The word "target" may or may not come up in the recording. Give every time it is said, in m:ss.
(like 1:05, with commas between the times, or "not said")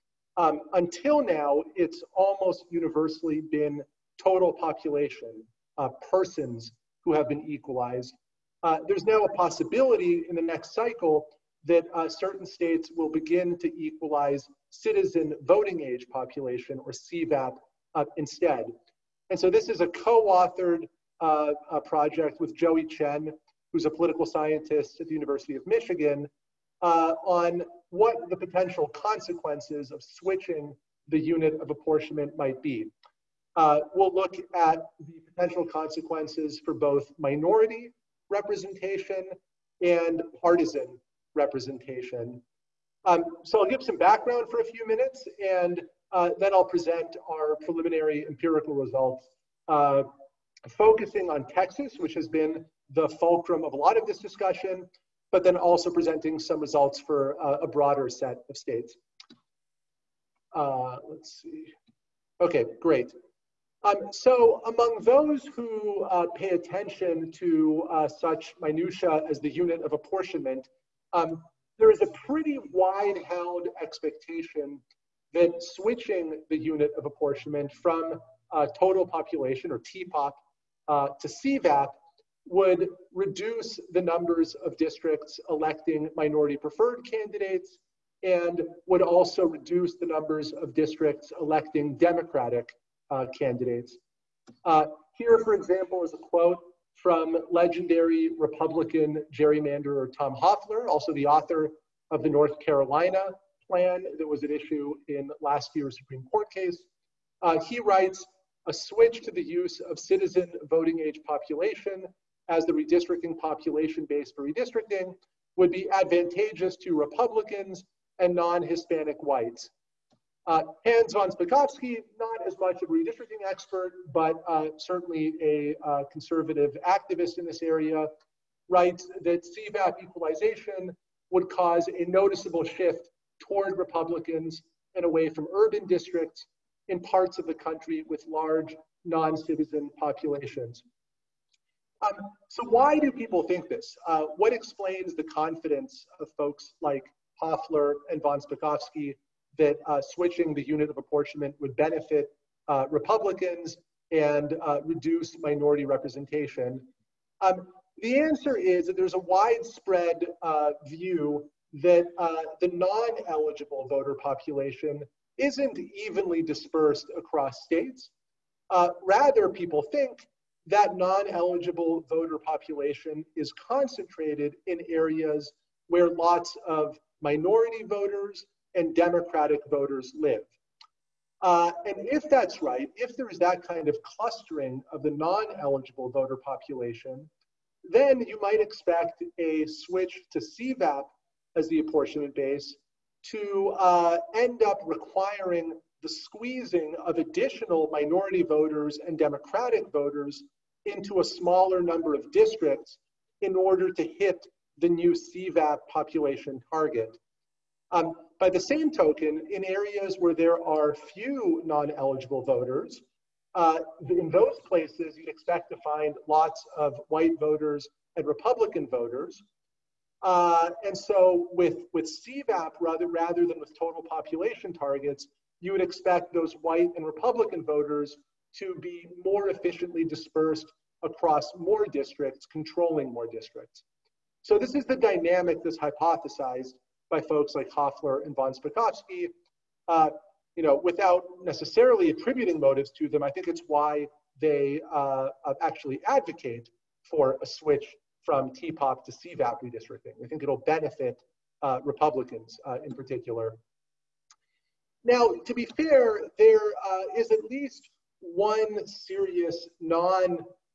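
3:26, 3:44.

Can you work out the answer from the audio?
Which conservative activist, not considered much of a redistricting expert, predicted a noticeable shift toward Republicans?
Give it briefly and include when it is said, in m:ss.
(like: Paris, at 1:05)
Hans von Spakovsky, at 2:00.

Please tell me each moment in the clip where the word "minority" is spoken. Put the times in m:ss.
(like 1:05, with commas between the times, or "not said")
0:37, 1:26, 2:35, 2:57, 3:17.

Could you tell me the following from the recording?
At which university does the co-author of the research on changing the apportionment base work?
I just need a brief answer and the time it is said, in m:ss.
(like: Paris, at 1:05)
University of Michigan, at 0:25.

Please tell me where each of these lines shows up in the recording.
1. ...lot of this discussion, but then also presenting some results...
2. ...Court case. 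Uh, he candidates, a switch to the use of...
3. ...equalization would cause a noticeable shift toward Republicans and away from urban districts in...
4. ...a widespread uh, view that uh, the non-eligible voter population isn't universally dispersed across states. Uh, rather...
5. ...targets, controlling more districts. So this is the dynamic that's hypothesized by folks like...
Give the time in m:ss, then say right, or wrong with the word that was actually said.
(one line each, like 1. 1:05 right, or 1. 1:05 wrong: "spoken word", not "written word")
1. 0:53 right
2. 1:46 wrong: "writes", not "candidates"
3. 2:10 right
4. 2:39 wrong: "evenly", not "universally"
5. 3:51 wrong: "districts", not "targets".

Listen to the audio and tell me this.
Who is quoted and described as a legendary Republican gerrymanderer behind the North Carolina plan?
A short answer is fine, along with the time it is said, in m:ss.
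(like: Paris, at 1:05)
Tom Hofeller, at 1:40.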